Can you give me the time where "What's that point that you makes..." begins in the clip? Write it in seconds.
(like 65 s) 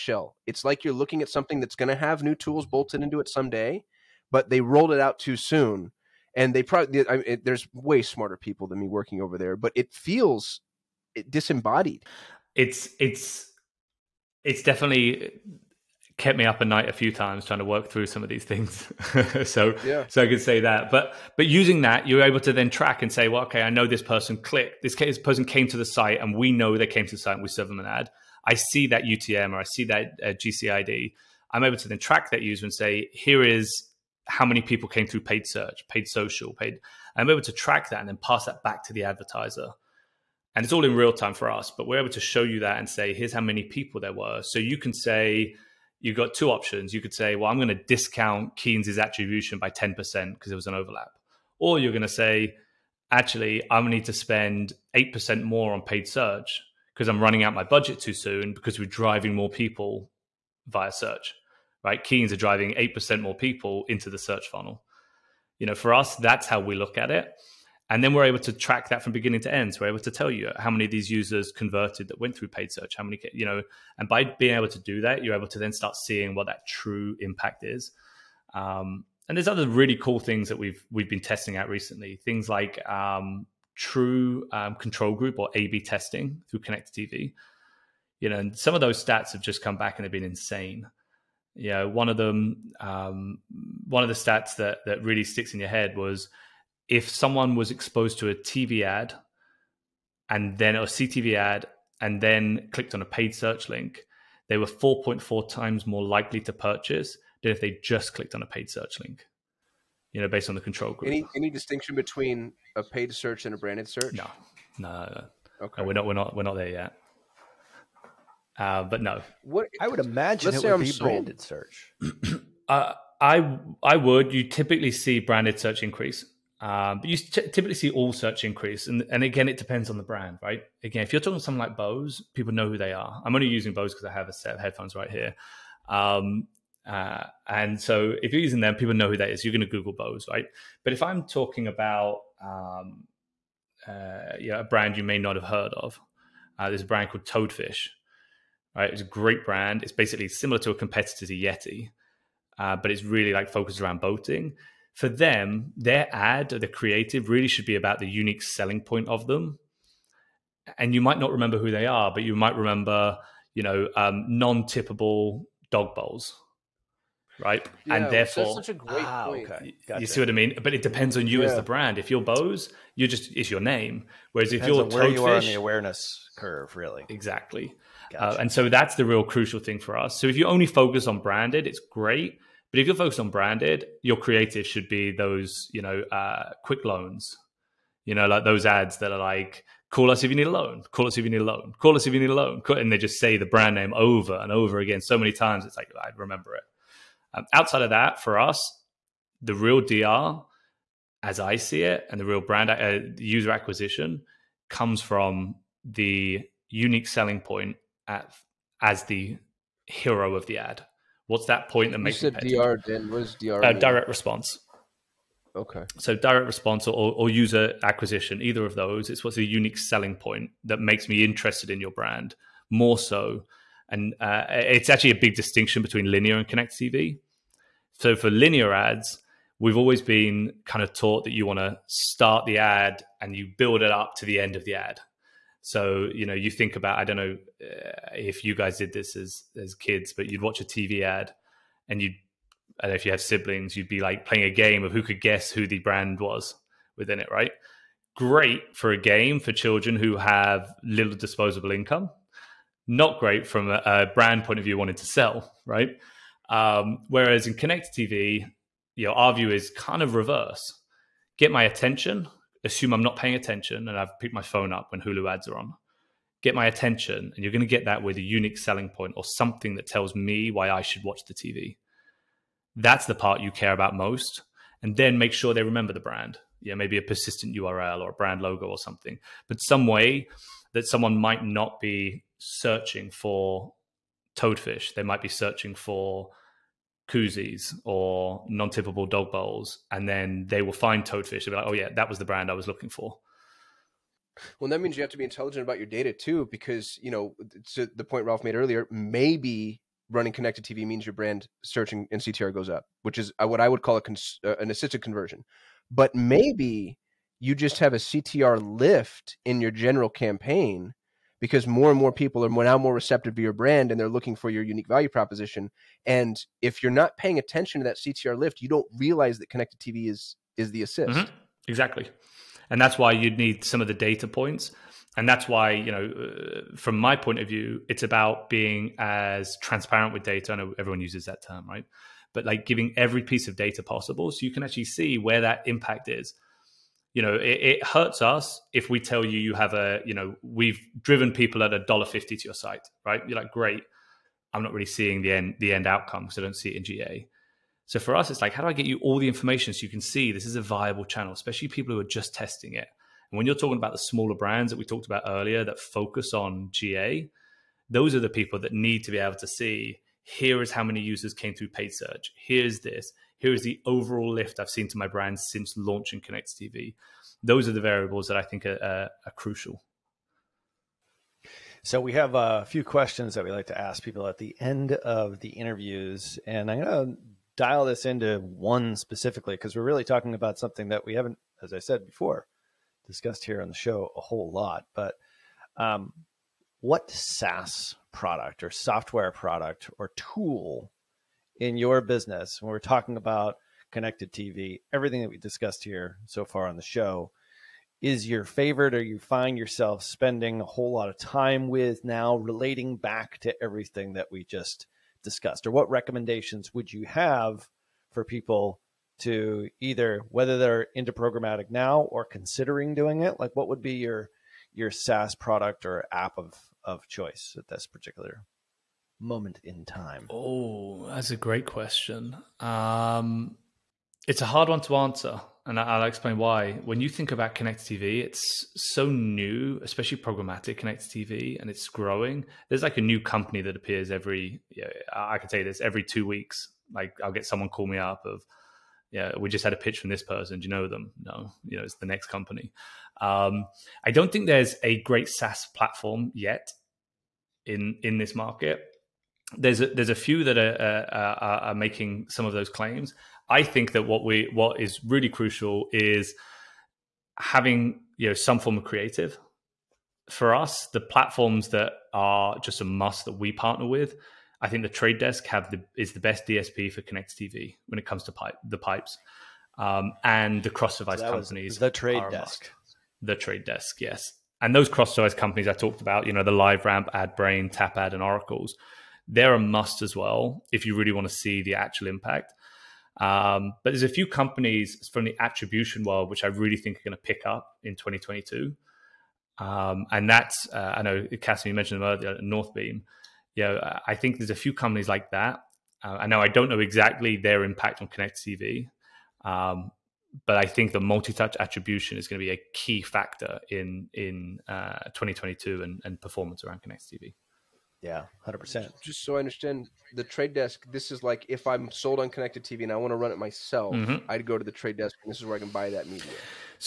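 211 s.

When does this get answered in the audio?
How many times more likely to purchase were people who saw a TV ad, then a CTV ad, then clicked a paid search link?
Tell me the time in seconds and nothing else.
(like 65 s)
104 s.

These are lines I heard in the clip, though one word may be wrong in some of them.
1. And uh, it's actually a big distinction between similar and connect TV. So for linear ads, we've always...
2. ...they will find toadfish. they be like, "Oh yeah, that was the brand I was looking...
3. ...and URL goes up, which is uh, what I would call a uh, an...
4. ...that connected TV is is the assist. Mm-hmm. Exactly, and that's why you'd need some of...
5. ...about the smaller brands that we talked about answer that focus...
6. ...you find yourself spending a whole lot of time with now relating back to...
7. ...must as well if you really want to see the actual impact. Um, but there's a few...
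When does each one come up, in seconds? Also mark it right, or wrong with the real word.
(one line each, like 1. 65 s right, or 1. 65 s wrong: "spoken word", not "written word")
1. 223 s wrong: "linear", not "similar"
2. 290 s right
3. 302 s wrong: "CTR", not "URL"
4. 319 s right
5. 353 s wrong: "earlier", not "answer"
6. 399 s right
7. 479 s right.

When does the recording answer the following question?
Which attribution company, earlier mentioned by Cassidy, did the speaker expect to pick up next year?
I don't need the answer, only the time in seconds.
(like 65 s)
492 s.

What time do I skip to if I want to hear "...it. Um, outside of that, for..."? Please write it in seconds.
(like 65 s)
196 s.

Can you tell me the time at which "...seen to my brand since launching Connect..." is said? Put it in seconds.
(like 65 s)
364 s.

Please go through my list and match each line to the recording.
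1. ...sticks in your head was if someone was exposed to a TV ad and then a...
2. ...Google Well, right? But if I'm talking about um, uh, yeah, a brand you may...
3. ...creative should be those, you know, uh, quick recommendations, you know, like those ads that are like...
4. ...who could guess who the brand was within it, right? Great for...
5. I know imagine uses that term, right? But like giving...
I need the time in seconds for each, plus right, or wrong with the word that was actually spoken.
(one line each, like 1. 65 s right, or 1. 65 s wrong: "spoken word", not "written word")
1. 95 s right
2. 139 s wrong: "Bose", not "Well"
3. 184 s wrong: "loans", not "recommendations"
4. 244 s right
5. 330 s wrong: "everyone", not "imagine".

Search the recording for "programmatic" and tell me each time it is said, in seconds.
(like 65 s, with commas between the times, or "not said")
411 s, 430 s.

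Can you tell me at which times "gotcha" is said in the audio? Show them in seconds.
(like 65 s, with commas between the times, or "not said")
169 s, 178 s.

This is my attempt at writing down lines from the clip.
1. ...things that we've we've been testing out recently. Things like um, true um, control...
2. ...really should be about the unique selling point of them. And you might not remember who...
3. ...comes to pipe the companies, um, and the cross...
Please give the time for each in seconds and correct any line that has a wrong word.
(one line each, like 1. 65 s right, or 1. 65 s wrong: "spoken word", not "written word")
1. 80 s right
2. 157 s right
3. 468 s wrong: "pipes", not "companies".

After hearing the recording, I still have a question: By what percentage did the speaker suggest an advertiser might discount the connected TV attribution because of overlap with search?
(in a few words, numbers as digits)
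10%.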